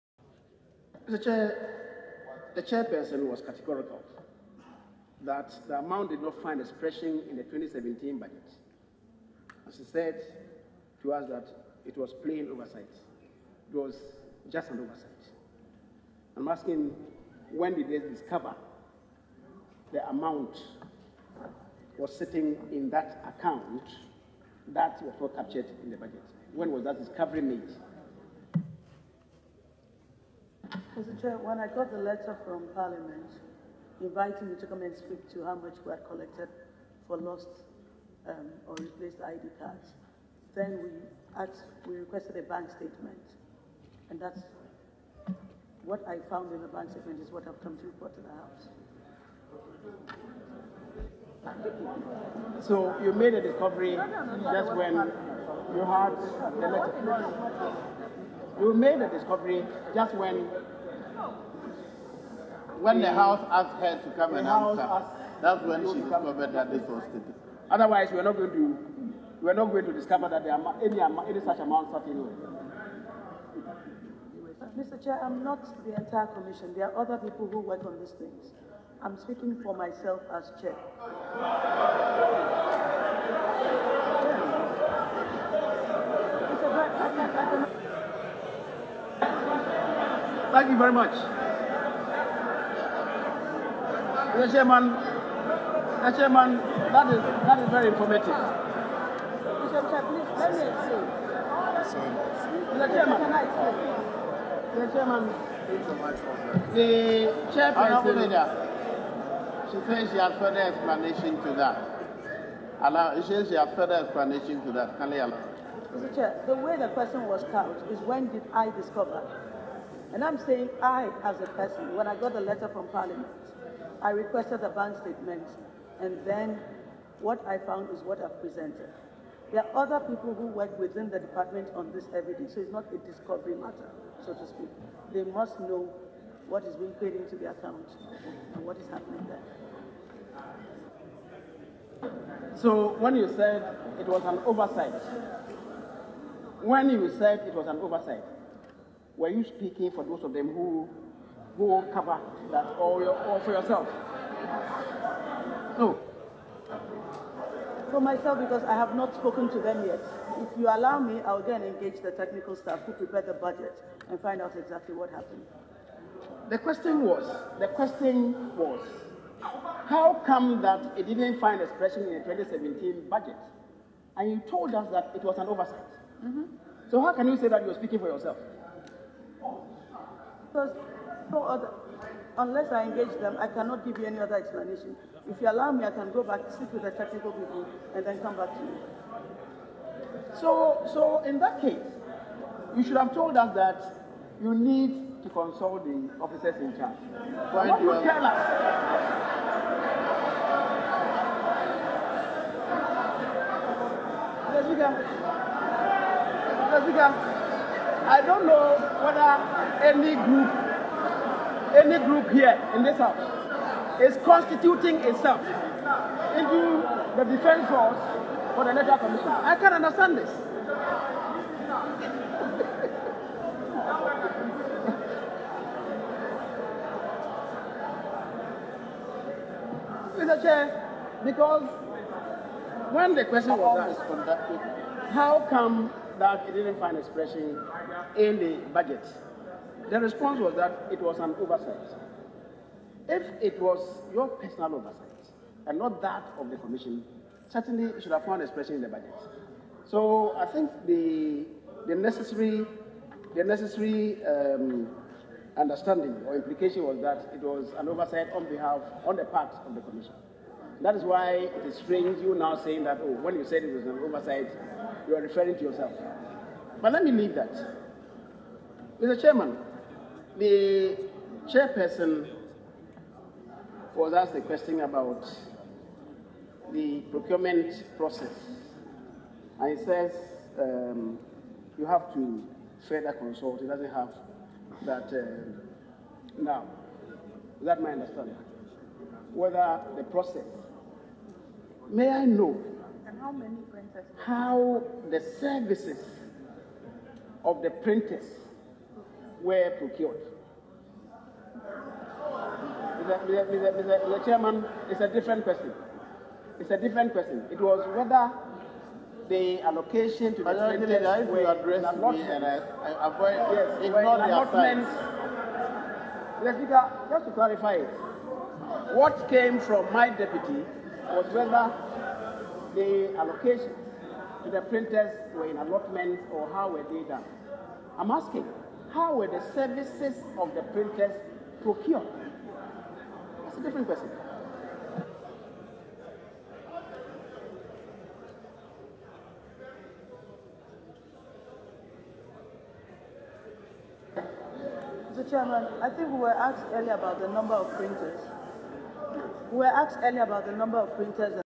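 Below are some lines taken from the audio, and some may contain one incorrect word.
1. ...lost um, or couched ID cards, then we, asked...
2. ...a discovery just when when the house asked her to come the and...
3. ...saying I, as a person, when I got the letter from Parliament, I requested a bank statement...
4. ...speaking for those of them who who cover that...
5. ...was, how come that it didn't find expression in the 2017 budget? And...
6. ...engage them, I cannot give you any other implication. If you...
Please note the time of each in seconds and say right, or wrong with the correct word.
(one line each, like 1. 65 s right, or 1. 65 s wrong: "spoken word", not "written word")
1. 37 s wrong: "replaced", not "couched"
2. 59 s right
3. 120 s right
4. 149 s right
5. 168 s right
6. 182 s wrong: "explanation", not "implication".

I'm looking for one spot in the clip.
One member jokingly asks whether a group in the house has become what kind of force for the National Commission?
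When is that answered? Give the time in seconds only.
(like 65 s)
217 s.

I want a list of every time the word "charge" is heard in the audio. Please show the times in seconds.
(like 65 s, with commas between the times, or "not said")
196 s.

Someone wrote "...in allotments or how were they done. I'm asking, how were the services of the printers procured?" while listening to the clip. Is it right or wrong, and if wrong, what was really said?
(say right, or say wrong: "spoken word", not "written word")
right.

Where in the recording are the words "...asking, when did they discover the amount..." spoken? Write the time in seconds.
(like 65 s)
16 s.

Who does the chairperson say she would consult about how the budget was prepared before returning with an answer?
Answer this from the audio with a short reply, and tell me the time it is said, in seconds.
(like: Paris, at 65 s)
Technical staff, at 162 s.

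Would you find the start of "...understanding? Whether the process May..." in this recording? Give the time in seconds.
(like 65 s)
287 s.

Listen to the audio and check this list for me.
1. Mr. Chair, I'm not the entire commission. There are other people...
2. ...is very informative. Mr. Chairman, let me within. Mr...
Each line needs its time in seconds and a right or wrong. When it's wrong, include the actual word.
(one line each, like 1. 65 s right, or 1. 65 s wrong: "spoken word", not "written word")
1. 74 s right
2. 97 s wrong: "explain", not "within".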